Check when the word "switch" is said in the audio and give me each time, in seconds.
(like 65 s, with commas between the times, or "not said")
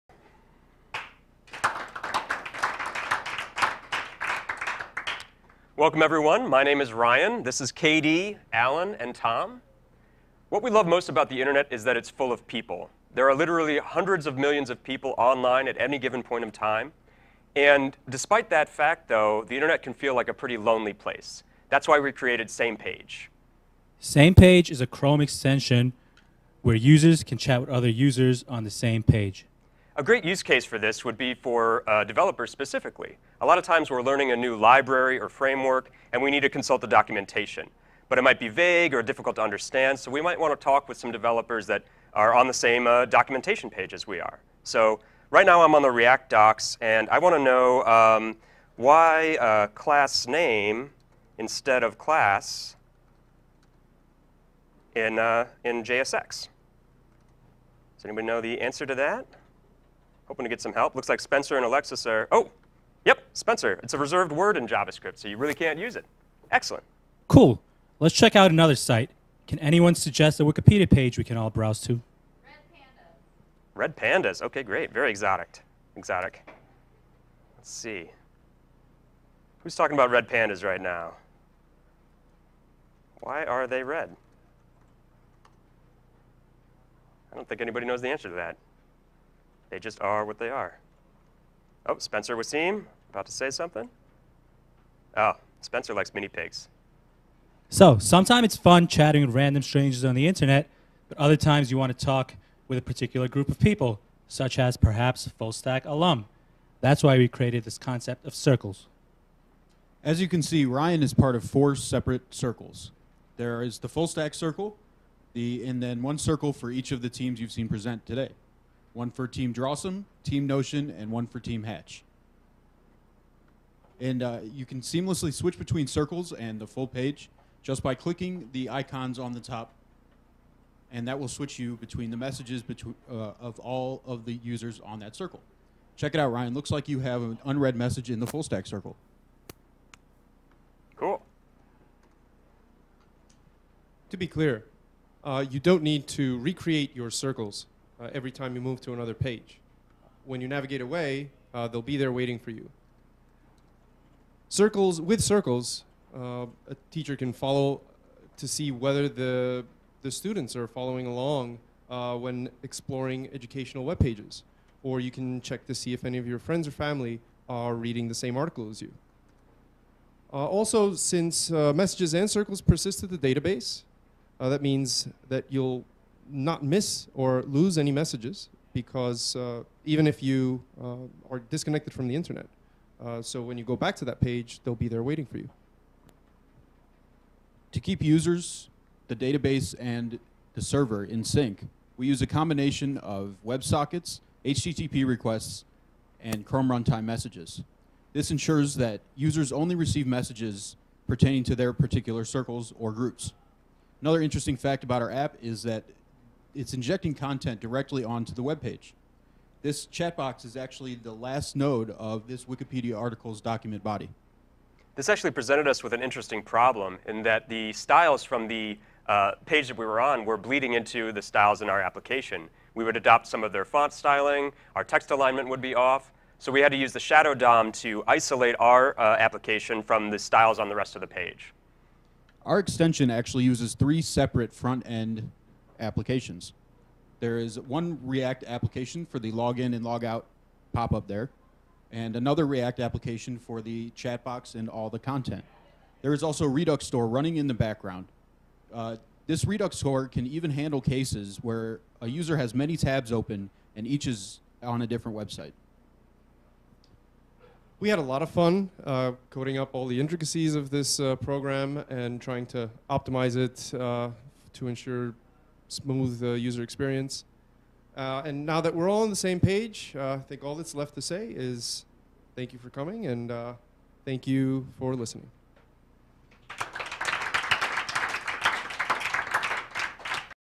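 125 s, 131 s.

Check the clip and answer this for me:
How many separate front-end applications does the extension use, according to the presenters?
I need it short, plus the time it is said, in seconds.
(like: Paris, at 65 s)
3, at 233 s.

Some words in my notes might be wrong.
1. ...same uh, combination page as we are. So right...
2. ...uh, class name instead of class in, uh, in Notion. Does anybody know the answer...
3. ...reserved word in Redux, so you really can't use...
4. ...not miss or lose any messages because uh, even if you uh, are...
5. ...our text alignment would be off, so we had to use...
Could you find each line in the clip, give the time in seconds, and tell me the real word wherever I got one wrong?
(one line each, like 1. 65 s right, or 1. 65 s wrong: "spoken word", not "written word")
1. 42 s wrong: "documentation", not "combination"
2. 49 s wrong: "JSX", not "Notion"
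3. 63 s wrong: "JavaScript", not "Redux"
4. 176 s right
5. 224 s right.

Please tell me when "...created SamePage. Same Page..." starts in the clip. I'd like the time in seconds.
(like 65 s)
22 s.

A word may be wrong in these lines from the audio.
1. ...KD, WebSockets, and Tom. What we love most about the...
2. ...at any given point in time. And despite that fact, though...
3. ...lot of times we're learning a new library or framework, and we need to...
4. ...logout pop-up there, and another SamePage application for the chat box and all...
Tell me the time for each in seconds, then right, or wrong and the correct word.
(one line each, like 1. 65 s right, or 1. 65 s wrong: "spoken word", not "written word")
1. 7 s wrong: "Alan", not "WebSockets"
2. 15 s right
3. 33 s right
4. 239 s wrong: "React", not "SamePage".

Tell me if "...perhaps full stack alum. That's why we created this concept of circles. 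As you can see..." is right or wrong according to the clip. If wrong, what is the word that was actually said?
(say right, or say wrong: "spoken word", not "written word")
right.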